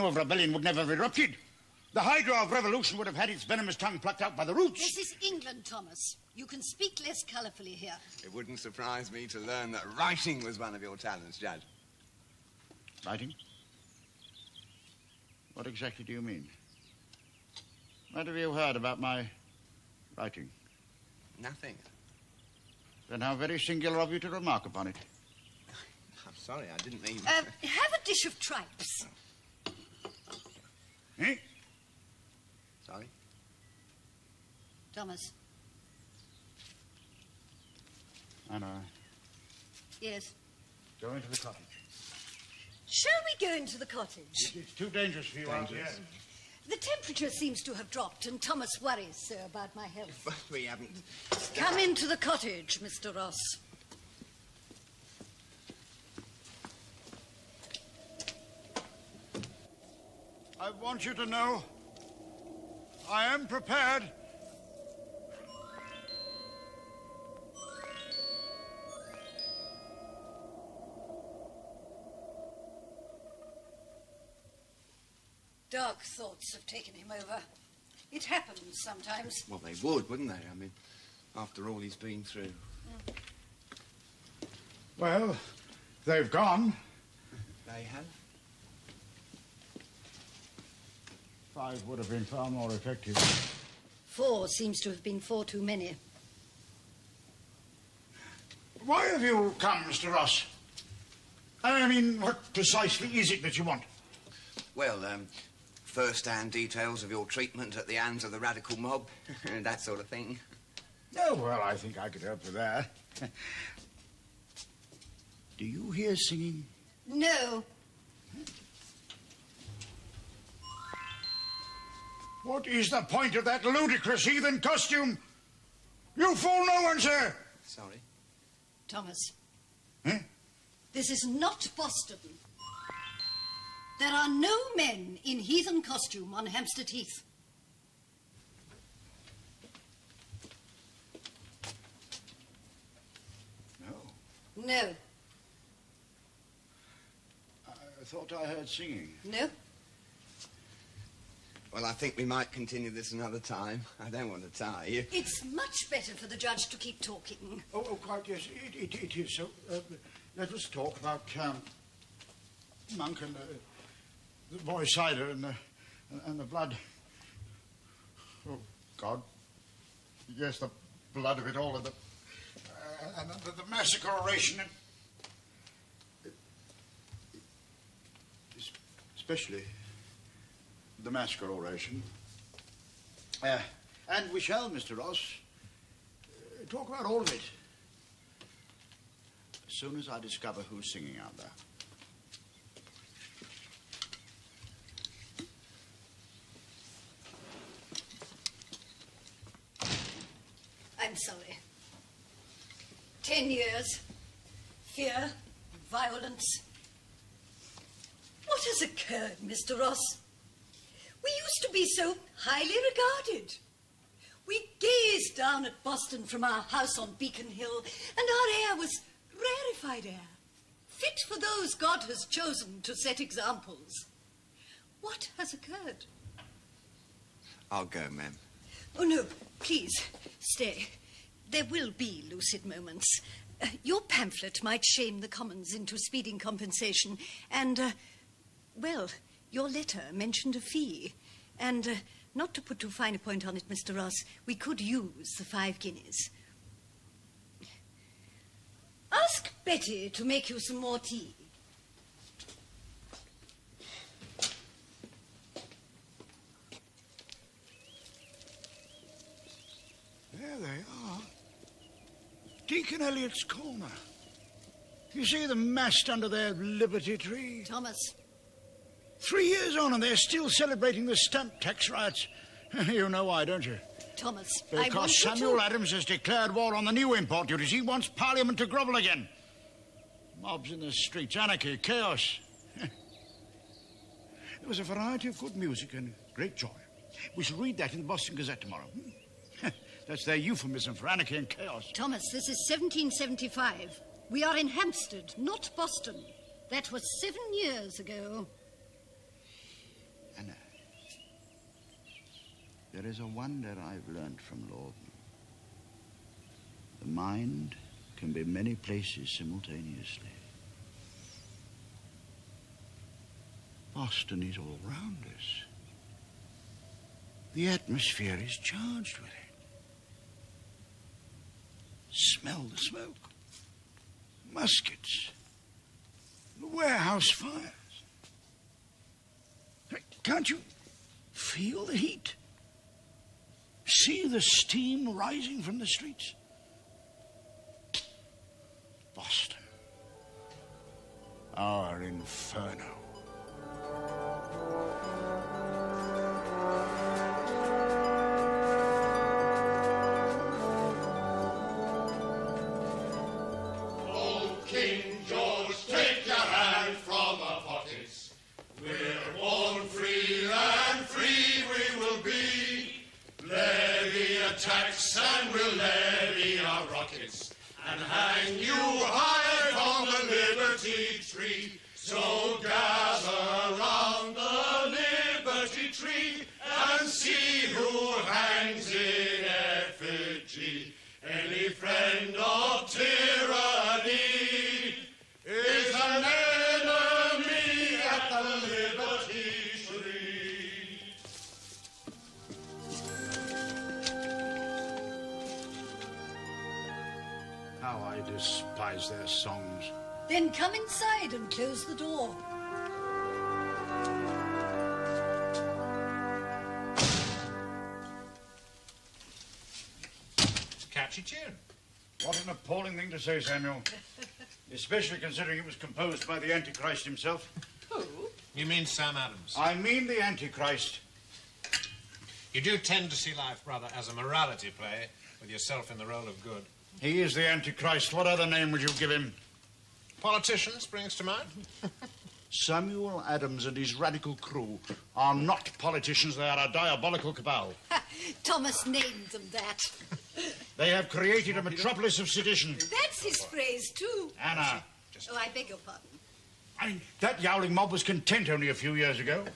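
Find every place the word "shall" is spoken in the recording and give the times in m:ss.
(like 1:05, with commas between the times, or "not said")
0:42, 3:04, 4:47.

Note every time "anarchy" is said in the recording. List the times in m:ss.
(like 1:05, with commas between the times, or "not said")
4:41, 4:51.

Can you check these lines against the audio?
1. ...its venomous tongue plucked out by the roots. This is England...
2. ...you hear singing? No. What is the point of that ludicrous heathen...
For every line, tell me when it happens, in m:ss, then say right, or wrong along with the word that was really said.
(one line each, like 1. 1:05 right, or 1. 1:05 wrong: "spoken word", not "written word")
1. 0:03 right
2. 1:55 right.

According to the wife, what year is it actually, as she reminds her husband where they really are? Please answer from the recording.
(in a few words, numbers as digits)
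1775.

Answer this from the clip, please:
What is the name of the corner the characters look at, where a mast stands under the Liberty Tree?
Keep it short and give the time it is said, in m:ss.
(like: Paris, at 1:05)
Deacon Elliot's Corner, at 4:22.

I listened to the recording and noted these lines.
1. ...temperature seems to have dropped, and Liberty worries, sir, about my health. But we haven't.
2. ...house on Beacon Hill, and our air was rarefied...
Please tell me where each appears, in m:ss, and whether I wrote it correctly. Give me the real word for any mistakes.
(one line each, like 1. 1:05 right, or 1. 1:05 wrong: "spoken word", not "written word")
1. 0:46 wrong: "Thomas", not "Liberty"
2. 3:36 right.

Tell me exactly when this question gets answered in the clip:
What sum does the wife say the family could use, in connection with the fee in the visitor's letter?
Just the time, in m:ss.
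4:05.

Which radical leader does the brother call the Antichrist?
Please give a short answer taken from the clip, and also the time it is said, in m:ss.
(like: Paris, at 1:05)
Sam Adams, at 6:58.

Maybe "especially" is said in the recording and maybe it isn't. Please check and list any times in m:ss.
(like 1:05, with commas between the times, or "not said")
2:59, 6:54.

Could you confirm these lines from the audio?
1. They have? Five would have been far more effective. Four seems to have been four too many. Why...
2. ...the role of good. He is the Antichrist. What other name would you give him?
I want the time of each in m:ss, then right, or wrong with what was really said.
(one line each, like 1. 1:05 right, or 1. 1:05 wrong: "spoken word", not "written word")
1. 1:27 right
2. 7:05 right.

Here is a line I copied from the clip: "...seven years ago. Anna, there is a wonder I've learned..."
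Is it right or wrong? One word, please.
right.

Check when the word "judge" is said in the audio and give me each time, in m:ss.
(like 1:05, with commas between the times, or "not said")
0:11, 2:36.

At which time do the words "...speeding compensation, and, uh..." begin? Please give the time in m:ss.
3:55.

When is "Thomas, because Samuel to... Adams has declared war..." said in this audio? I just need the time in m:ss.
4:34.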